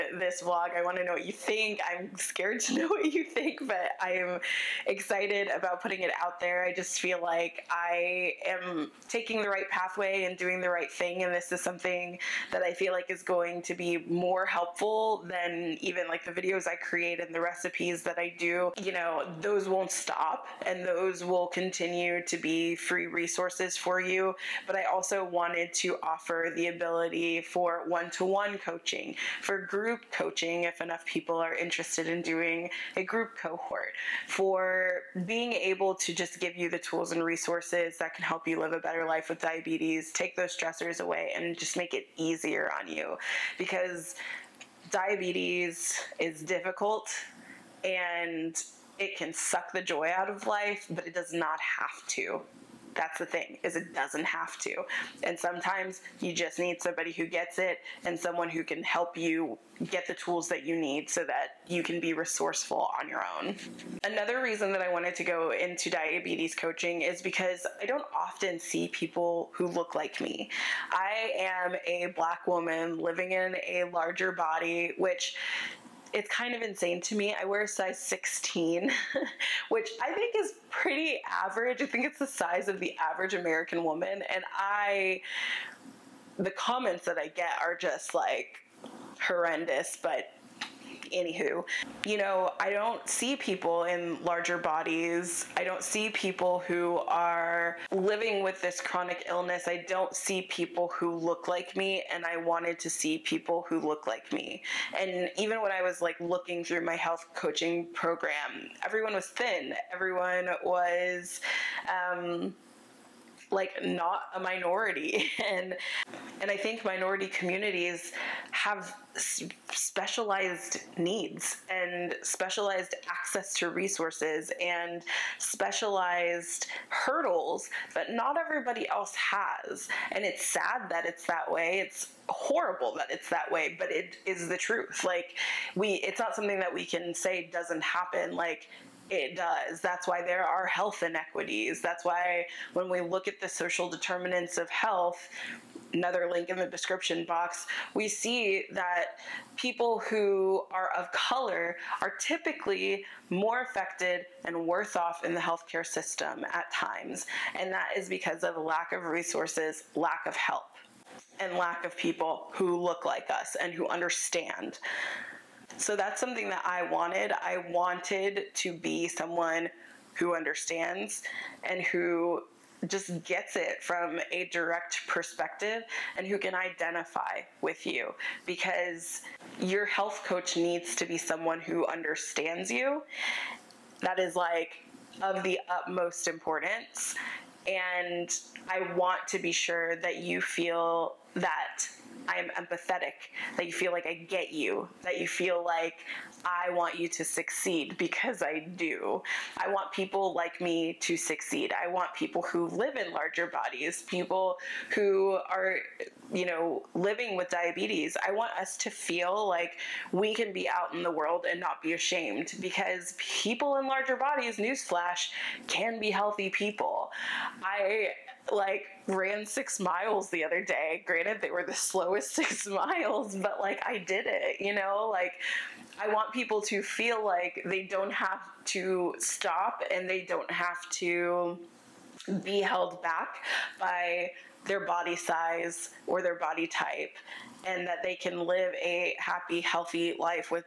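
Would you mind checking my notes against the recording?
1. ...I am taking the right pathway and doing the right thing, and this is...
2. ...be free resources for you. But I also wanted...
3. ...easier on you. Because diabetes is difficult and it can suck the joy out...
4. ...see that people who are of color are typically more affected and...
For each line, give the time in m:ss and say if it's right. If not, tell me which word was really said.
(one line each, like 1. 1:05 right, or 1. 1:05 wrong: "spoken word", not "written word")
1. 0:07 right
2. 0:22 right
3. 0:42 right
4. 2:28 right.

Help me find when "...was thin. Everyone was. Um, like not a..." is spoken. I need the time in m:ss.
1:49.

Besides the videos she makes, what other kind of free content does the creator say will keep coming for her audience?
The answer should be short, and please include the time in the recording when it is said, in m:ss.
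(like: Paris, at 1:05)
recipes, at 0:17.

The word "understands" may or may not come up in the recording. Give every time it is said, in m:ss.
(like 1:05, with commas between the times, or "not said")
2:43, 2:50, 3:01.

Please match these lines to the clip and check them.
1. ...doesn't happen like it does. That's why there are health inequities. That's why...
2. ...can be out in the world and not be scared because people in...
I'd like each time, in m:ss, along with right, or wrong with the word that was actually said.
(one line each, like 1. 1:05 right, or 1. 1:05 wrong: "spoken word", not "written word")
1. 2:17 right
2. 3:30 wrong: "ashamed", not "scared".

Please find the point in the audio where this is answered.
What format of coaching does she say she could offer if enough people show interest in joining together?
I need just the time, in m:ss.
0:33.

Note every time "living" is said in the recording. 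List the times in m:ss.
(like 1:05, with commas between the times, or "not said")
1:12, 1:37, 3:26.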